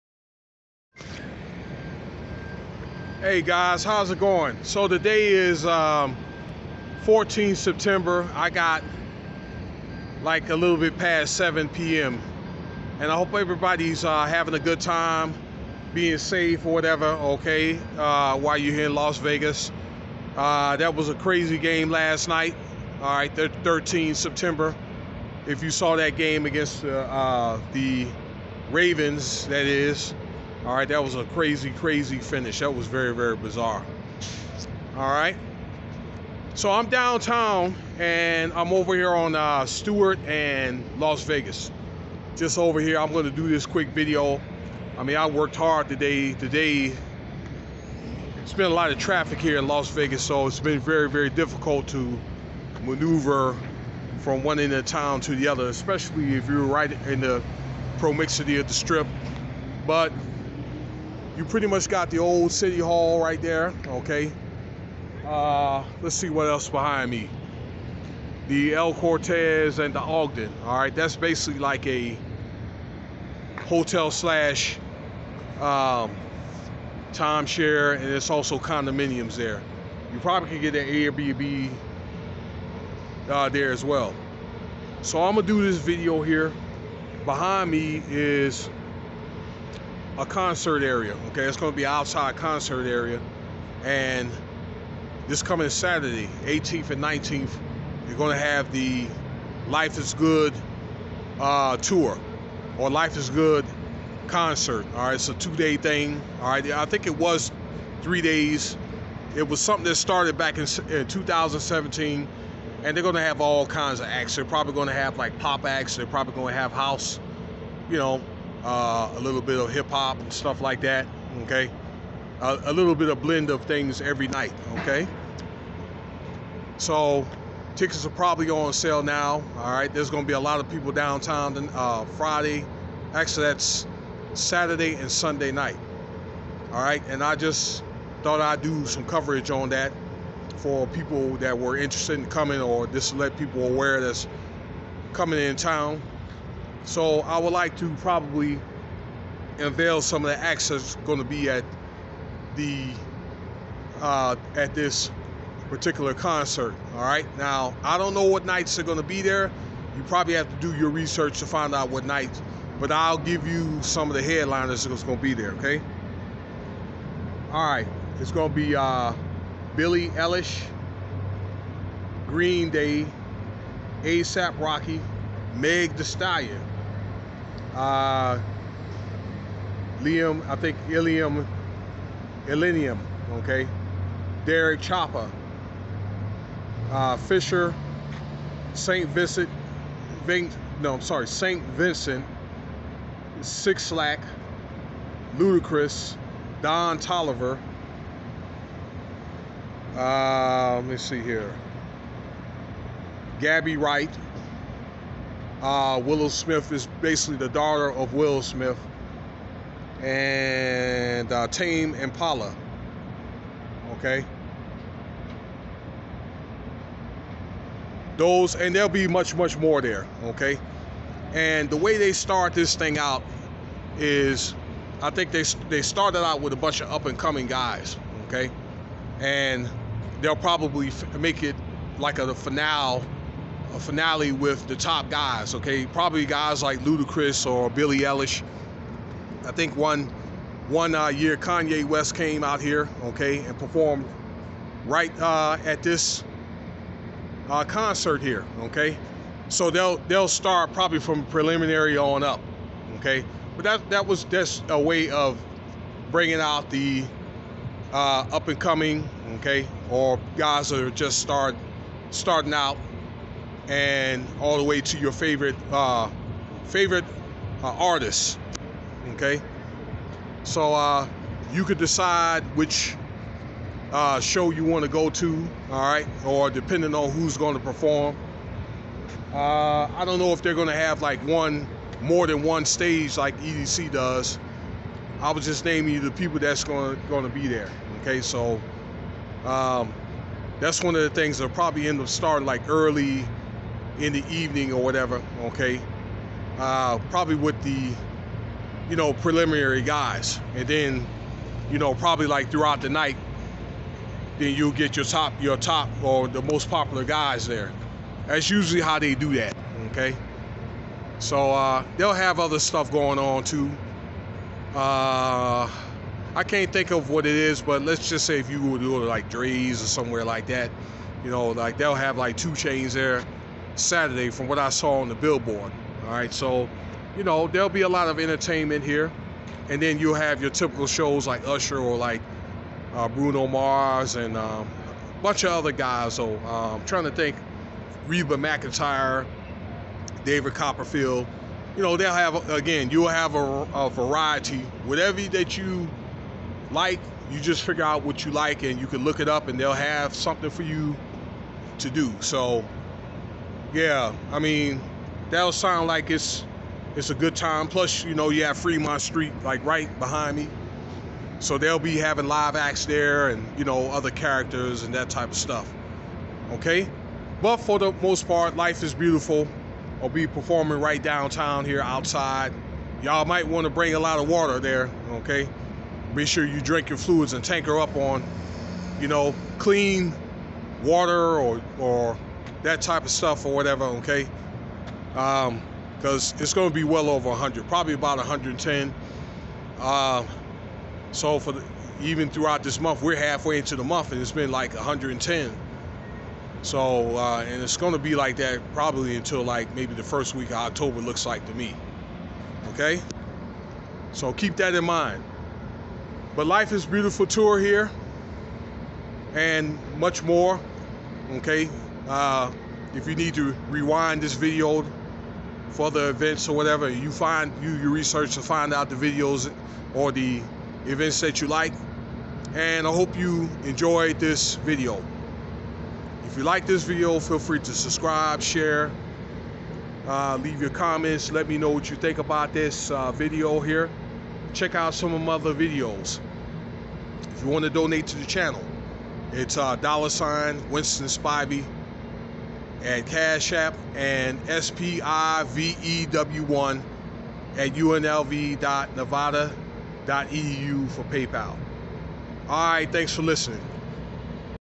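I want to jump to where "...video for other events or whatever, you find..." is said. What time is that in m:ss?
6:54.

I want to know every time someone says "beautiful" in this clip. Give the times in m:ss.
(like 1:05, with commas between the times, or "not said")
6:08, 6:46.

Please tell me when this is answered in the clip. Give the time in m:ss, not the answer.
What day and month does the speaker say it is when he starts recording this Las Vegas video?
0:07.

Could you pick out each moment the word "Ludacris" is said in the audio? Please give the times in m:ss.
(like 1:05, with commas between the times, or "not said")
3:15, 3:56.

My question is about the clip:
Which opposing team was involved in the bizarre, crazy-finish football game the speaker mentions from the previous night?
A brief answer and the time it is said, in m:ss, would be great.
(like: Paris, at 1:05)
Ravens, at 0:28.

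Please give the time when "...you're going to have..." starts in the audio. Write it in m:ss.
1:38.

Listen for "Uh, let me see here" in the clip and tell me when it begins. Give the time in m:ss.
3:19.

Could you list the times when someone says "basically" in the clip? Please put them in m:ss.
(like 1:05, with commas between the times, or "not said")
1:11, 3:27.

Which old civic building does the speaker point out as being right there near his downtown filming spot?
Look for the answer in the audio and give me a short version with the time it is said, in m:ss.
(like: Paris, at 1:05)
Old City Hall, at 1:02.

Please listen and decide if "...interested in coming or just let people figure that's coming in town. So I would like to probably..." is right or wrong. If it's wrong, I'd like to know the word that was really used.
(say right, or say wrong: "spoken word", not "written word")
wrong: "aware", not "figure".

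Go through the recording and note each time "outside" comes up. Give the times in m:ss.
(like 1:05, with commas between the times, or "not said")
1:31, 6:11.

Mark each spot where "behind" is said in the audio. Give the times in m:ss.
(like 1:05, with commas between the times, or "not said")
1:06, 1:27, 5:59.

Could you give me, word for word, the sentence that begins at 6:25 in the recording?
Because um, it's going to be well over 100, probably about 110.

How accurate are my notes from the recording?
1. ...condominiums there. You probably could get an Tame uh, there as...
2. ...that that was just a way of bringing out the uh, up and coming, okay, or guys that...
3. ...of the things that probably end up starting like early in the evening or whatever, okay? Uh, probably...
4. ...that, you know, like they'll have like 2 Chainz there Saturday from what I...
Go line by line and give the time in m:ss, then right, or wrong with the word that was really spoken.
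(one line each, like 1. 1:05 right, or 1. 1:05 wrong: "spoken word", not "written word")
1. 1:18 wrong: "Airbnb", not "Tame"
2. 4:13 right
3. 4:50 right
4. 5:20 right.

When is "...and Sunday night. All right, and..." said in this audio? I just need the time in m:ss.
2:14.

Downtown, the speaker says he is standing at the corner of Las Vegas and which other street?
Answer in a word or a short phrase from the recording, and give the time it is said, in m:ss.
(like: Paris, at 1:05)
Stewart, at 0:39.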